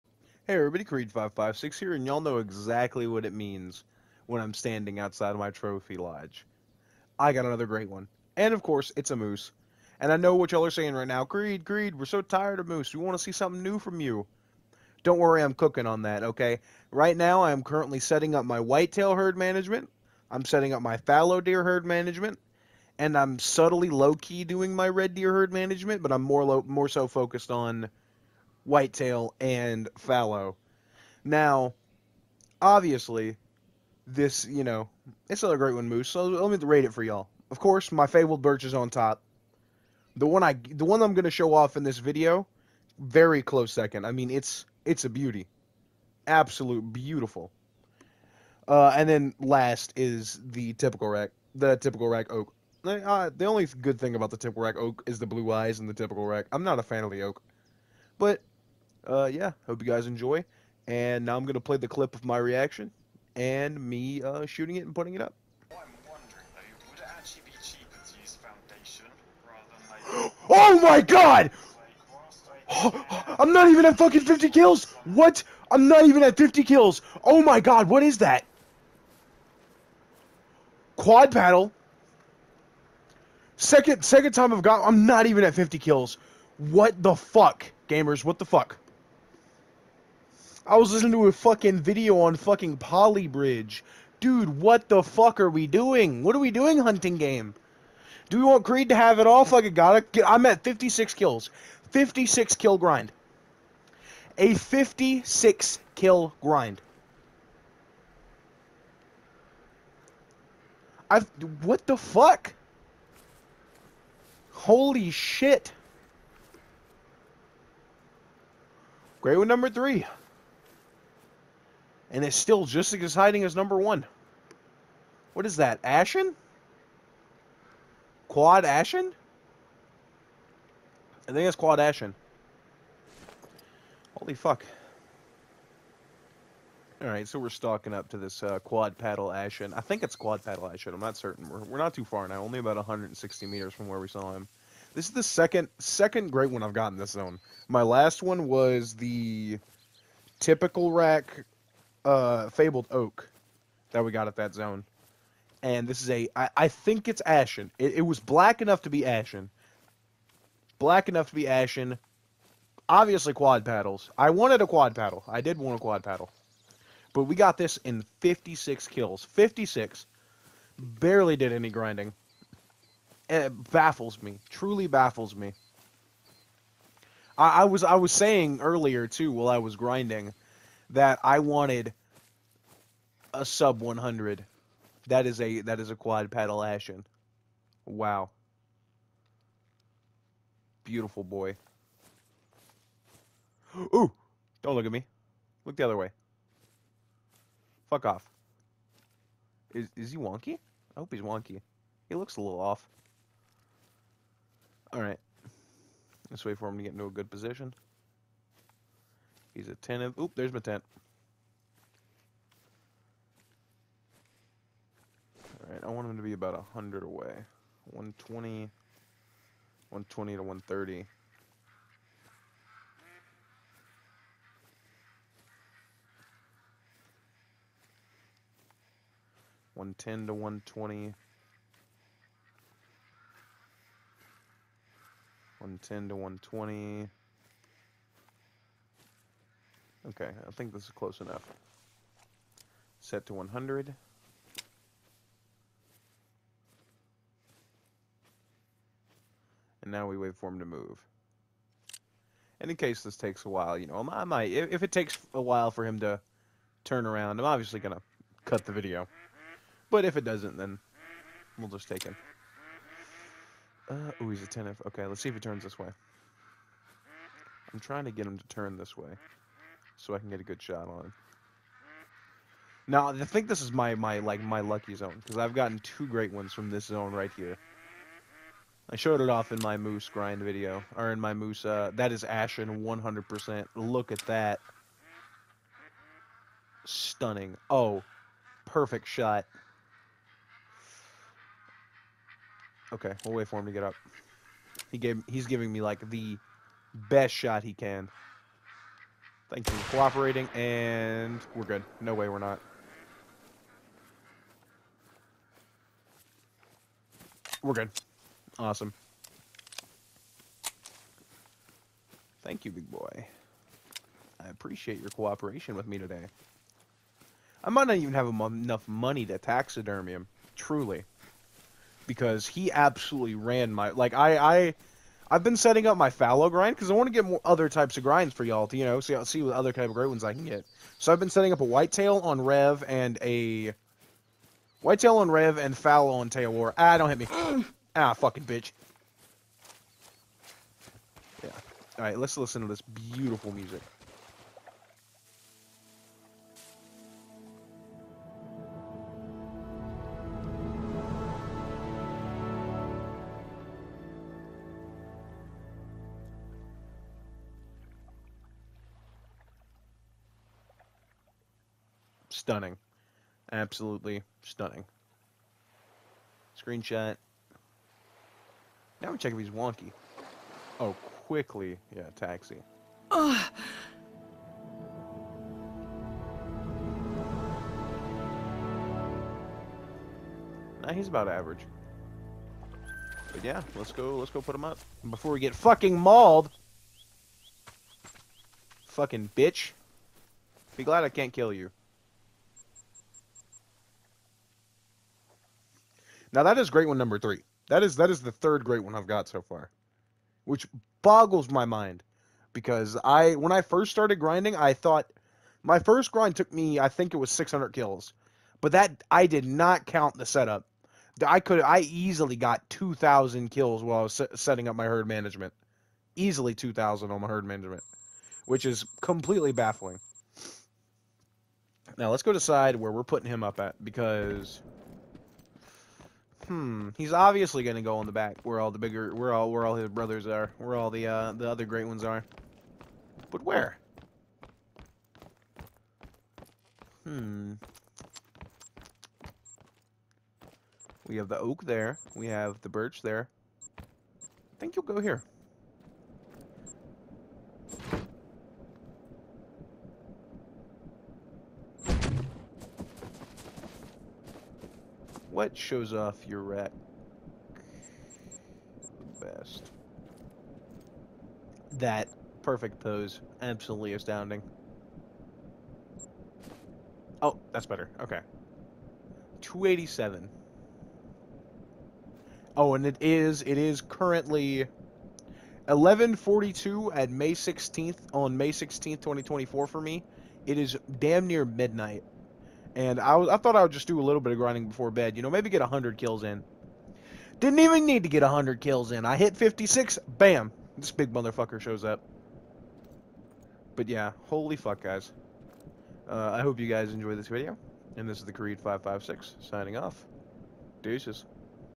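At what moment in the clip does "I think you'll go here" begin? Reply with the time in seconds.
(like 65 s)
443 s.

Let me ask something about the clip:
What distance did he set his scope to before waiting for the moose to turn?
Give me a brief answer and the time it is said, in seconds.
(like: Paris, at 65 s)
100, at 243 s.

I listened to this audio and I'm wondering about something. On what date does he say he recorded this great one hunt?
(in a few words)
May 16th, 2024.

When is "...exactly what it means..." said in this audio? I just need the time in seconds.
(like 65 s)
2 s.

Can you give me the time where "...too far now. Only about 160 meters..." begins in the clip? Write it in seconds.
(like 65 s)
141 s.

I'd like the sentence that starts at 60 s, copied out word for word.
And now I'm going to play the clip of my reaction and me uh, shooting it and putting it up.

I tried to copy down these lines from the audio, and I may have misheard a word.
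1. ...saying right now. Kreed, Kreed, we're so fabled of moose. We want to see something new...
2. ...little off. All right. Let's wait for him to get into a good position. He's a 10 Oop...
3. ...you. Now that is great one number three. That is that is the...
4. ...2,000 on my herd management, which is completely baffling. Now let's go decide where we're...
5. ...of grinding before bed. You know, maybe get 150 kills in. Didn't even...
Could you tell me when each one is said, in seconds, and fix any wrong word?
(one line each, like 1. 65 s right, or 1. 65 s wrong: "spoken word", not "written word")
1. 10 s wrong: "tired", not "fabled"
2. 202 s right
3. 391 s right
4. 416 s right
5. 484 s wrong: "100", not "150".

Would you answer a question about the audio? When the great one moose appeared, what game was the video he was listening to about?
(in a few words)
Poly Bridge.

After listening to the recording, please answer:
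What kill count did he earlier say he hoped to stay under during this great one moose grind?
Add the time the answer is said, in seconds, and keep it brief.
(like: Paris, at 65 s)
sub 100, at 183 s.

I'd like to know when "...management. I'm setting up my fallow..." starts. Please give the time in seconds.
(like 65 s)
19 s.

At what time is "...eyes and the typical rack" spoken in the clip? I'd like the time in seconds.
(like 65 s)
55 s.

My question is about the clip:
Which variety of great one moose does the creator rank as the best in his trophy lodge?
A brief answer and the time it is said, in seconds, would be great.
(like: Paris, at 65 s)
Fabled birch, at 38 s.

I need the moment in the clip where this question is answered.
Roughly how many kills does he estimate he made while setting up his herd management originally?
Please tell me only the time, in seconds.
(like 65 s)
412 s.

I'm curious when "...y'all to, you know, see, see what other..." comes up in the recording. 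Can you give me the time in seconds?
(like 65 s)
328 s.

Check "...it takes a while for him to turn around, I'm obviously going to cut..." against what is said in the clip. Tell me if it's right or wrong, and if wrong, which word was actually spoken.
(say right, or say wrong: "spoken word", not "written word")
right.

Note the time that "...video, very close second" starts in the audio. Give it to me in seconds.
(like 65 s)
41 s.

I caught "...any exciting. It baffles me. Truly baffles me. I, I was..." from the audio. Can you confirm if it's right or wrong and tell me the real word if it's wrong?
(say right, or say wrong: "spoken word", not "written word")
wrong: "grinding", not "exciting".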